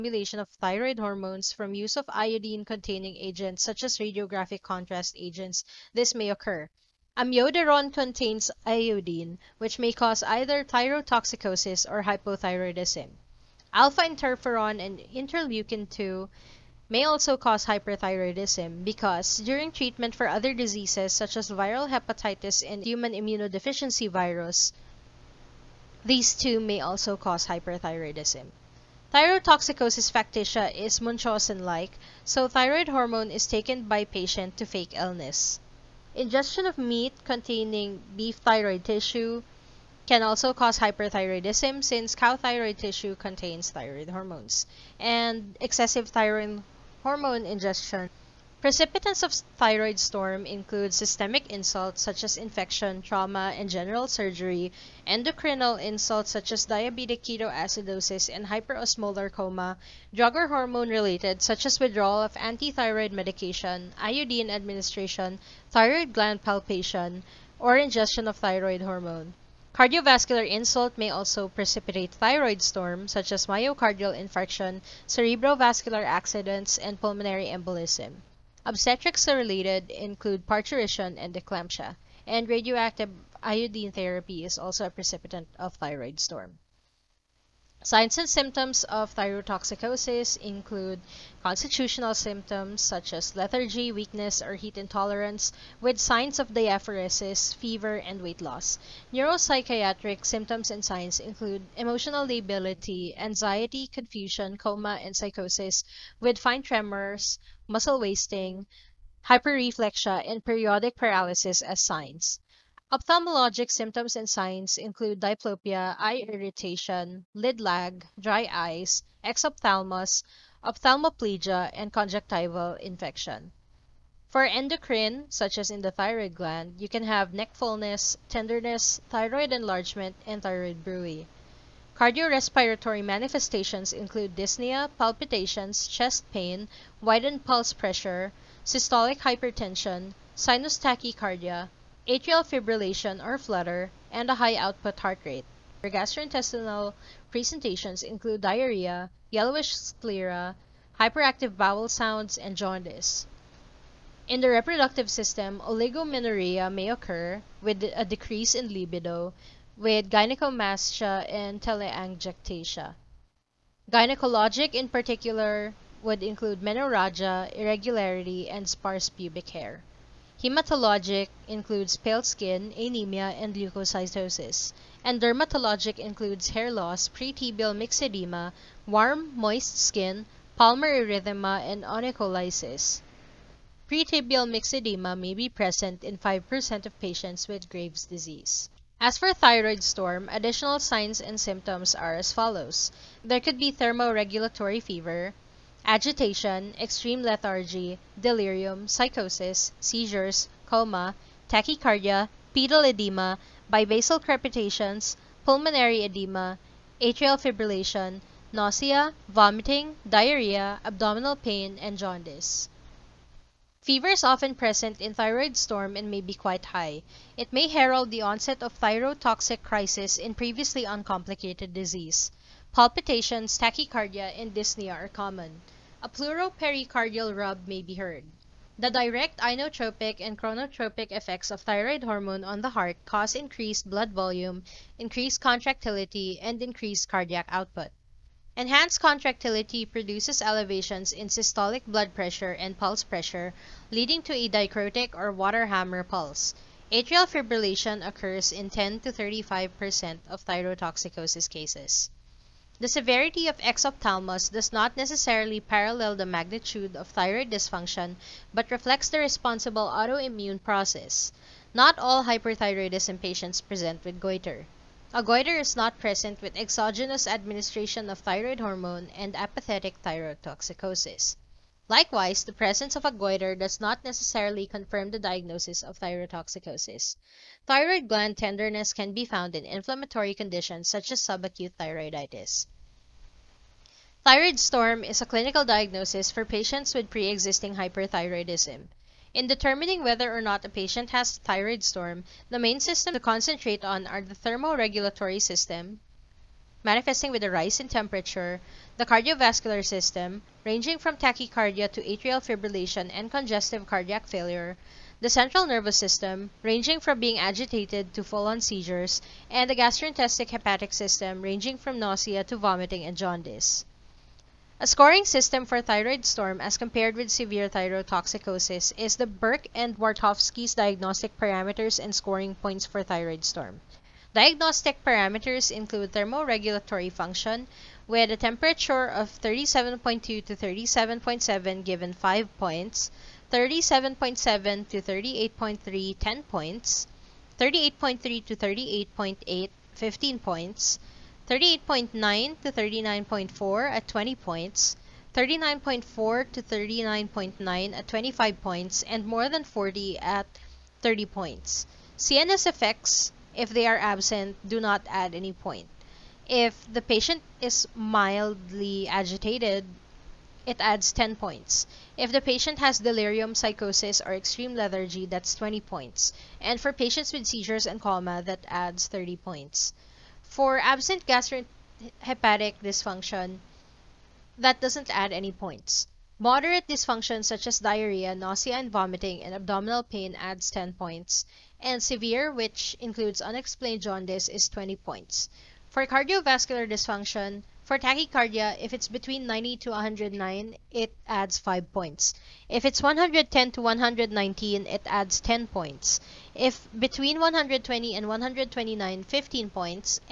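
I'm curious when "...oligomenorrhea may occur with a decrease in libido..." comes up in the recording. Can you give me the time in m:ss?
2:35.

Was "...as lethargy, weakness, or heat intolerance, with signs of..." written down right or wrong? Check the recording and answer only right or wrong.
right.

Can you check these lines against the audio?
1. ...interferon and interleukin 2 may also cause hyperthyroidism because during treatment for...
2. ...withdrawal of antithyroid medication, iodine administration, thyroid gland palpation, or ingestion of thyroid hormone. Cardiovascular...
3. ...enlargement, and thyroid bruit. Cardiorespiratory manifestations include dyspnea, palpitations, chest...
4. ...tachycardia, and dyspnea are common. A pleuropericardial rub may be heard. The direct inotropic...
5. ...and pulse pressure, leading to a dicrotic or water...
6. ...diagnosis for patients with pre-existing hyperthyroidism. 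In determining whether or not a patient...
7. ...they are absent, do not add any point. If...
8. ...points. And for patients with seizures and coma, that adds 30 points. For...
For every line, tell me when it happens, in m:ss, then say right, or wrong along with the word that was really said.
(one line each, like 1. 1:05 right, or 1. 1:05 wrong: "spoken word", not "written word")
1. 0:14 right
2. 1:01 right
3. 2:09 right
4. 3:43 right
5. 4:02 right
6. 4:45 right
7. 5:53 right
8. 6:05 right.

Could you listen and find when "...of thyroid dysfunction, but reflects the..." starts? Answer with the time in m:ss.
4:16.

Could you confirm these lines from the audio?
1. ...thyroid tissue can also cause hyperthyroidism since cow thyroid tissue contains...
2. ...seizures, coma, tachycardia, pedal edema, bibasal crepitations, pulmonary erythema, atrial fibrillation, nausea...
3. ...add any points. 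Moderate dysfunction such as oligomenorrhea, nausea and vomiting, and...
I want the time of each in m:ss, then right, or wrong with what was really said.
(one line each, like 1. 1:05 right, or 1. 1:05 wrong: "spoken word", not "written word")
1. 0:38 right
2. 3:19 wrong: "edema", not "erythema"
3. 6:15 wrong: "diarrhea", not "oligomenorrhea".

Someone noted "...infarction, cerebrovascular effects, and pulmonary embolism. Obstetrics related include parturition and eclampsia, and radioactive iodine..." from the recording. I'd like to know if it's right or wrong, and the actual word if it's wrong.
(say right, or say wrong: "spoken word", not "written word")
wrong: "accidents", not "effects".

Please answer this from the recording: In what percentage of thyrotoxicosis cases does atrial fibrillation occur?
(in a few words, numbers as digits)
10 to 35%.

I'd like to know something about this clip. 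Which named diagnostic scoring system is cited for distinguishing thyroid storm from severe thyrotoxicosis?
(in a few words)
Burch and Wartofsky.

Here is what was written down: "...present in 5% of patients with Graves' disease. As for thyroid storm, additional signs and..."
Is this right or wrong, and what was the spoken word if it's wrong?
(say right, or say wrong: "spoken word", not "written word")
right.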